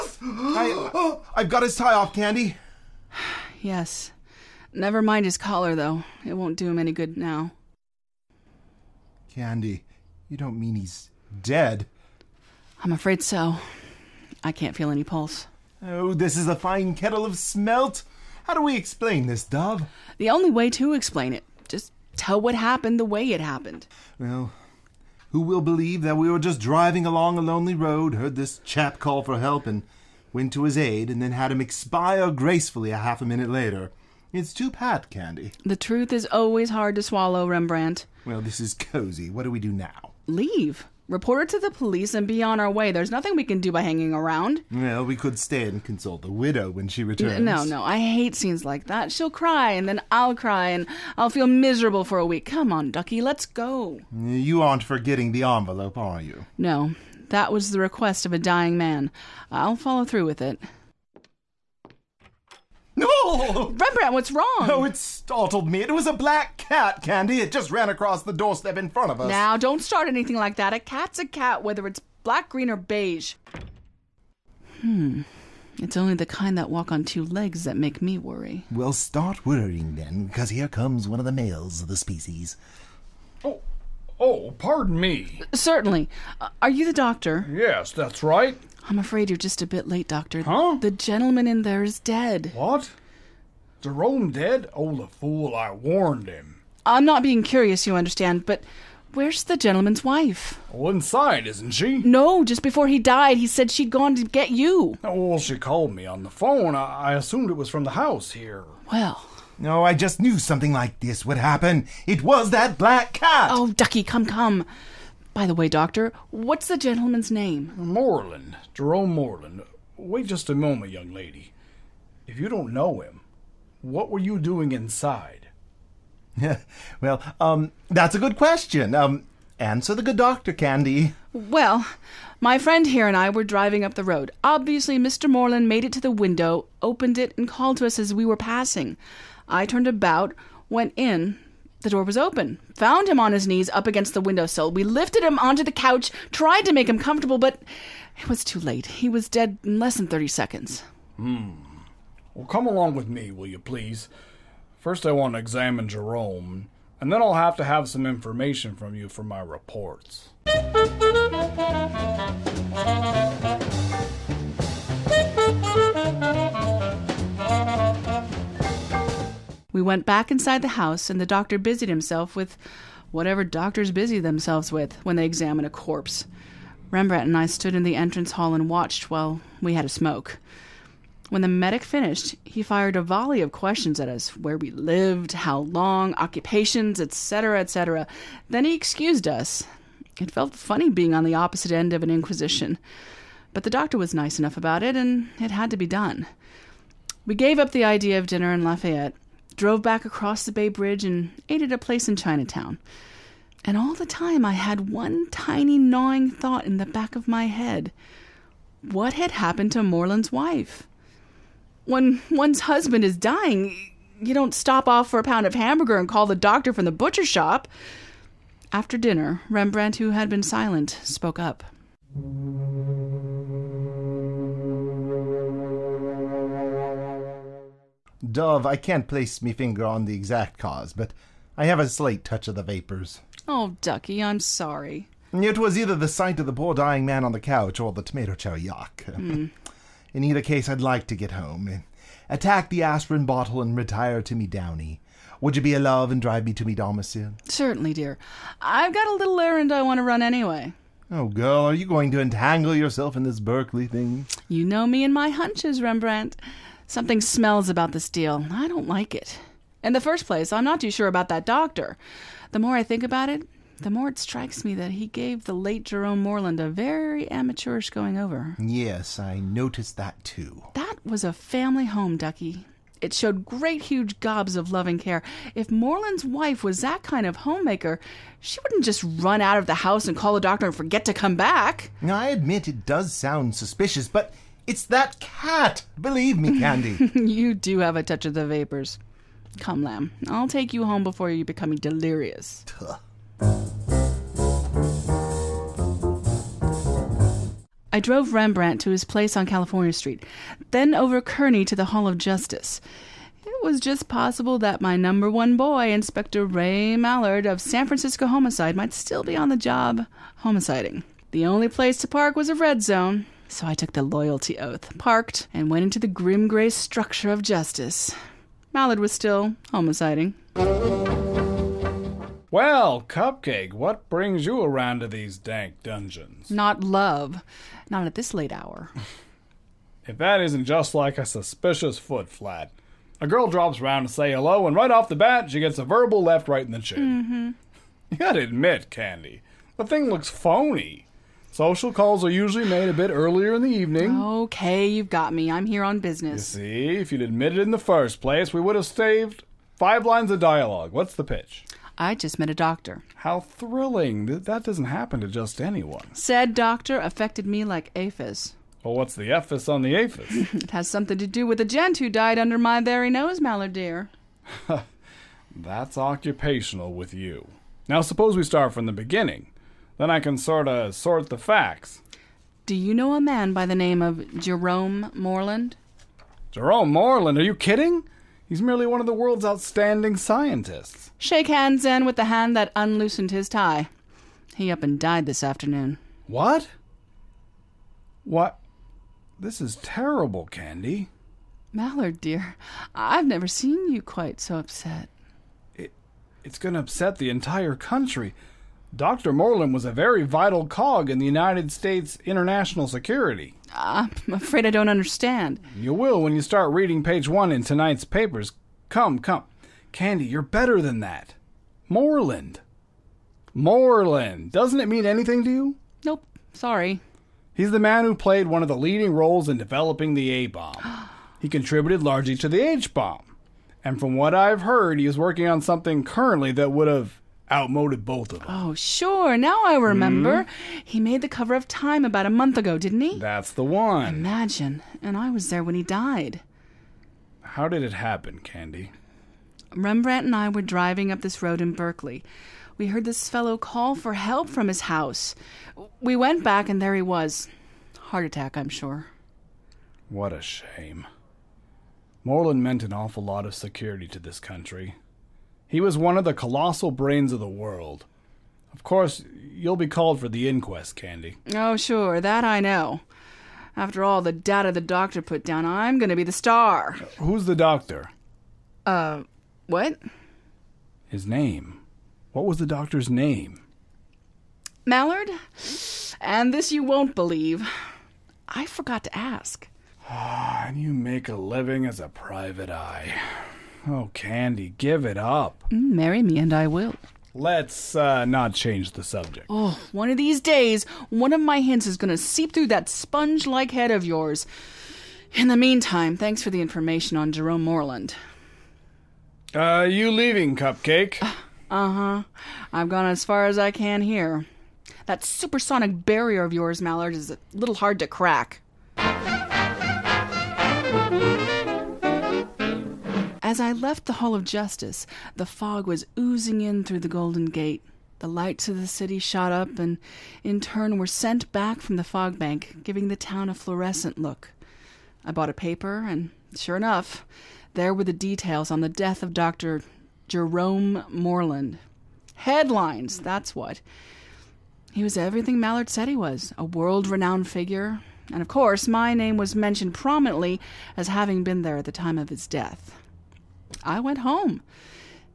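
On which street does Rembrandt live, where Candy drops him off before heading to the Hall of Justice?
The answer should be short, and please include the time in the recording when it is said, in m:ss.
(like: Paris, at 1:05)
California Street, at 4:59.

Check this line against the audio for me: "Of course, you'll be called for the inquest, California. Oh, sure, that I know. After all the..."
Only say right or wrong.
wrong.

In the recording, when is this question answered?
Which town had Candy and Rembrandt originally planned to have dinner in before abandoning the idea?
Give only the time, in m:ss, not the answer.
3:18.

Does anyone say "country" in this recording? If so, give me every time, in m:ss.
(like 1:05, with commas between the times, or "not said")
6:37, 7:34.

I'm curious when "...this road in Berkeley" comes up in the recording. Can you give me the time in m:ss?
7:21.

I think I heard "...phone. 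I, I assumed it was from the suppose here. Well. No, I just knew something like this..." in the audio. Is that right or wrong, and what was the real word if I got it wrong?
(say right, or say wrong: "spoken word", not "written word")
wrong: "house", not "suppose".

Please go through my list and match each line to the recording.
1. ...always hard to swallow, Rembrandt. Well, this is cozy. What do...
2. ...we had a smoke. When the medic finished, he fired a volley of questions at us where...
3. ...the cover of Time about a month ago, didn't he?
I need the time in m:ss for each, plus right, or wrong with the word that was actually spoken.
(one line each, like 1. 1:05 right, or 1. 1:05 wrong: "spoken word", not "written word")
1. 0:36 right
2. 2:59 right
3. 7:11 right.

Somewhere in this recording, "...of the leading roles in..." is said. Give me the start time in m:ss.
6:58.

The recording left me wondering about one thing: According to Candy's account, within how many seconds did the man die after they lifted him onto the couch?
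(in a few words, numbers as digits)
30.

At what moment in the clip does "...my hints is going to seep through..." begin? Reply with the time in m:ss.
8:11.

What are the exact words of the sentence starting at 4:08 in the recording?
I've got a little errand I want to run anyway.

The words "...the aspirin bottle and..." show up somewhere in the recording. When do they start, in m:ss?
4:02.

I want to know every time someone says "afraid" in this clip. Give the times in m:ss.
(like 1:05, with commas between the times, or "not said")
0:12, 1:28, 6:44.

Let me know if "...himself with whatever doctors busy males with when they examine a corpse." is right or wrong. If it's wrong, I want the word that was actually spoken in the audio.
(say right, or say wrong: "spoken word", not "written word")
wrong: "themselves", not "males".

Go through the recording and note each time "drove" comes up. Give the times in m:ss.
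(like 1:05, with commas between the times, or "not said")
3:19, 4:57.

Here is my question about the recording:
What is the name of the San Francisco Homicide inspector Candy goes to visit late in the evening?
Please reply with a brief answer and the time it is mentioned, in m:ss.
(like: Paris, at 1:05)
Ray Mallard, at 5:06.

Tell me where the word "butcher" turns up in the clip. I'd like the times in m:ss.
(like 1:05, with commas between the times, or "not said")
3:36.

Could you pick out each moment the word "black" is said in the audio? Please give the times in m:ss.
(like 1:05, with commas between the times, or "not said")
1:06, 1:12, 1:52.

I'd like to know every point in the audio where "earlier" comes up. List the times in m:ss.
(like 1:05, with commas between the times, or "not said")
5:43.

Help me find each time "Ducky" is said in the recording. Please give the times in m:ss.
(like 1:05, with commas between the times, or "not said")
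0:52, 1:53, 3:53, 4:32.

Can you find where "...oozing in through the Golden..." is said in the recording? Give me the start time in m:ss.
8:36.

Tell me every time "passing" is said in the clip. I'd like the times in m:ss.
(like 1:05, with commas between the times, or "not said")
2:18.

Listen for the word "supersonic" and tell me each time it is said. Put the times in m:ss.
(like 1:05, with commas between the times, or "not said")
8:25.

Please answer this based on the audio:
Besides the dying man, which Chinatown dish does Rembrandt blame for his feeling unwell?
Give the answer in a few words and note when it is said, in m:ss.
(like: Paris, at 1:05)
Tomato chow yuk, at 3:58.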